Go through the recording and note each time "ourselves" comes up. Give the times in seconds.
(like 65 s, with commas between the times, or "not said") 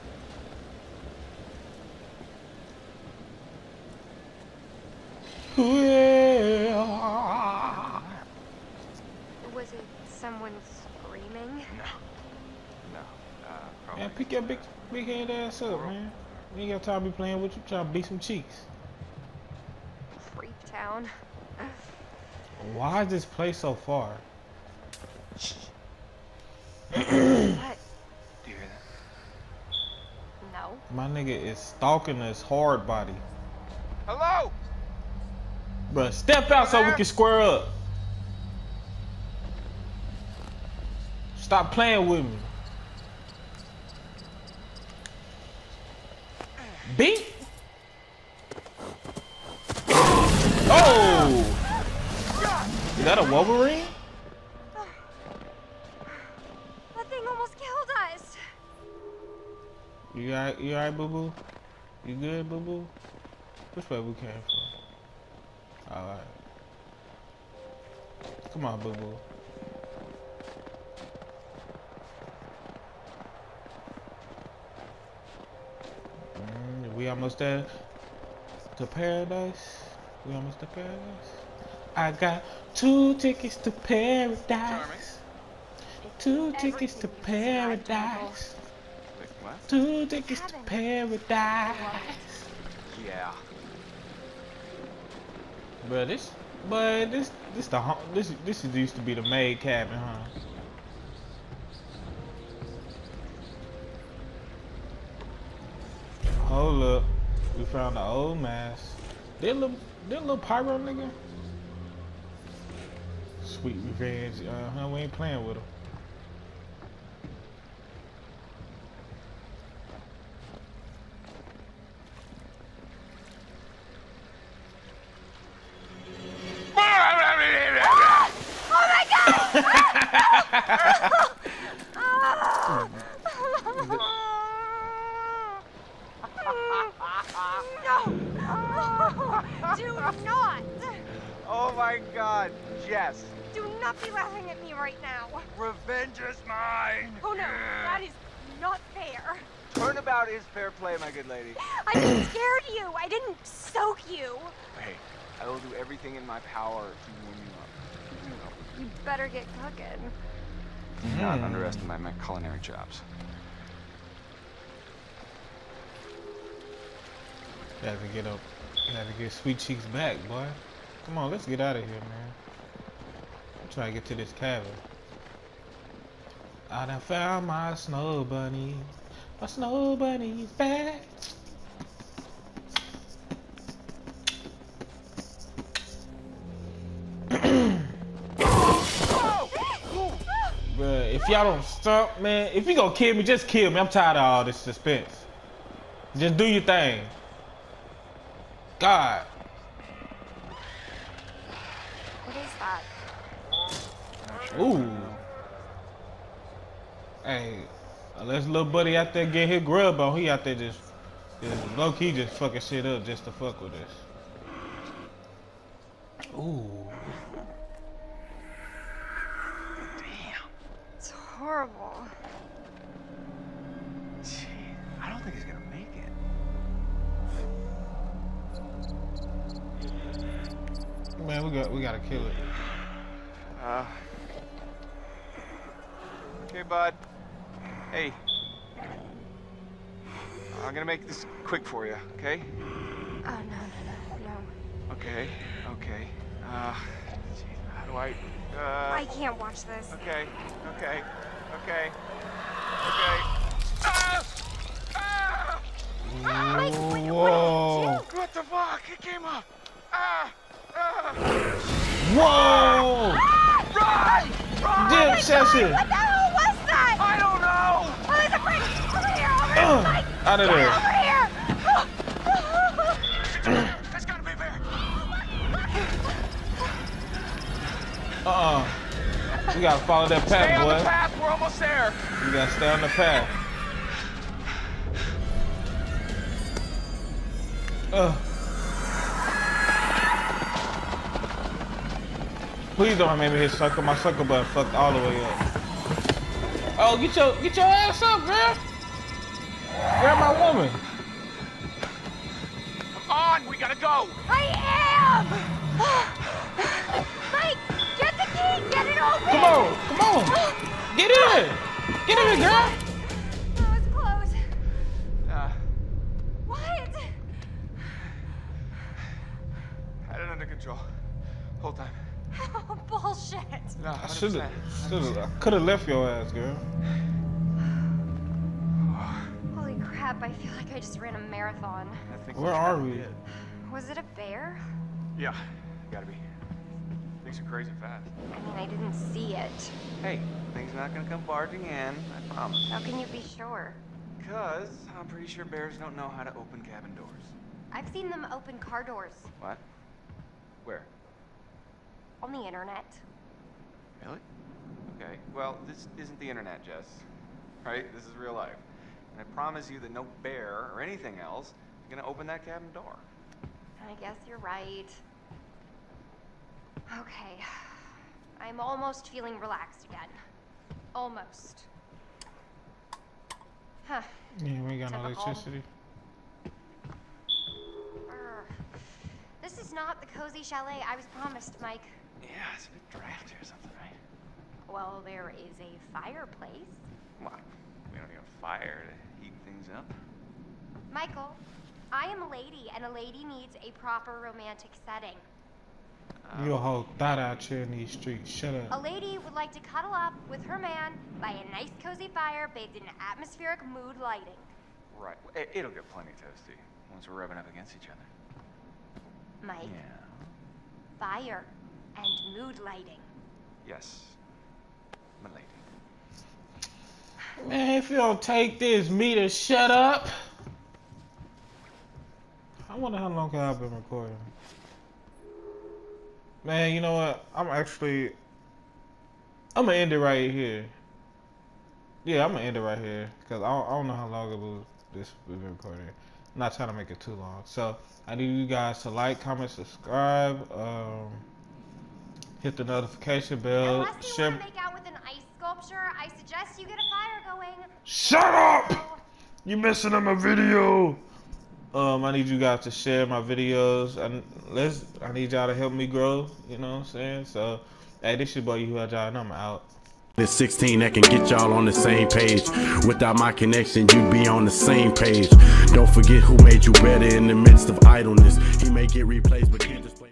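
not said.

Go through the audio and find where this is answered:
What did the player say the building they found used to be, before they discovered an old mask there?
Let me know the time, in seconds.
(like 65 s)
99 s.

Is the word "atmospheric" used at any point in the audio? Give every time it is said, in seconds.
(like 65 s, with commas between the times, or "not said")
403 s.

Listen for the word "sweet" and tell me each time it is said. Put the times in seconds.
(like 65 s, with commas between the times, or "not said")
113 s, 169 s.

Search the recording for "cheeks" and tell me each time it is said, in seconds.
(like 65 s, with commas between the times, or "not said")
18 s, 169 s.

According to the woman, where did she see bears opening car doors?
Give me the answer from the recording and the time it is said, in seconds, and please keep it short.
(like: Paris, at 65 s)
On the internet, at 352 s.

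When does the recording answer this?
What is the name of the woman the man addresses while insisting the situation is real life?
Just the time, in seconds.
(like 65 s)
356 s.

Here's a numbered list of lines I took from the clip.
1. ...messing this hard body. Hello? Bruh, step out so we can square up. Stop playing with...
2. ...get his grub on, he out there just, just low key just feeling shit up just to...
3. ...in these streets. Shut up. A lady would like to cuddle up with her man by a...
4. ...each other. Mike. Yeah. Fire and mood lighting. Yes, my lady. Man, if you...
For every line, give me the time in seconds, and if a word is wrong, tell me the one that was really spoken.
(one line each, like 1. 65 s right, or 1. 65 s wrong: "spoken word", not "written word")
1. 31 s wrong: "stalking", not "messing"
2. 209 s wrong: "fucking", not "feeling"
3. 397 s right
4. 407 s right.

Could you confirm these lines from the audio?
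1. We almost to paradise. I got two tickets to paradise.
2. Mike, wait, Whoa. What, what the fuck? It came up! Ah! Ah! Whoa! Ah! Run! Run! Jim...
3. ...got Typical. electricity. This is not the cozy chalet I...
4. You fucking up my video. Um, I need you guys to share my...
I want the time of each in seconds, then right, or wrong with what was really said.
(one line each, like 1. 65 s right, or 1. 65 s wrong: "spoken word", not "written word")
1. 80 s right
2. 256 s right
3. 374 s right
4. 449 s wrong: "messing", not "fucking".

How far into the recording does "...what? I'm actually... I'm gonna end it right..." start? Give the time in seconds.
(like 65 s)
426 s.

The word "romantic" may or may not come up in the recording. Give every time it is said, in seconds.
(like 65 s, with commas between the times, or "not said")
394 s.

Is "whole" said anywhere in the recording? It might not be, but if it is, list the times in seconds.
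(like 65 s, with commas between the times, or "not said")
321 s, 396 s.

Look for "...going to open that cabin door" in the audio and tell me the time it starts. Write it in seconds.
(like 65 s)
361 s.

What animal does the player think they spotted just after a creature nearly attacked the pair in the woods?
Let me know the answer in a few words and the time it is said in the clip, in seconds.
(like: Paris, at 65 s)
Wolverine, at 53 s.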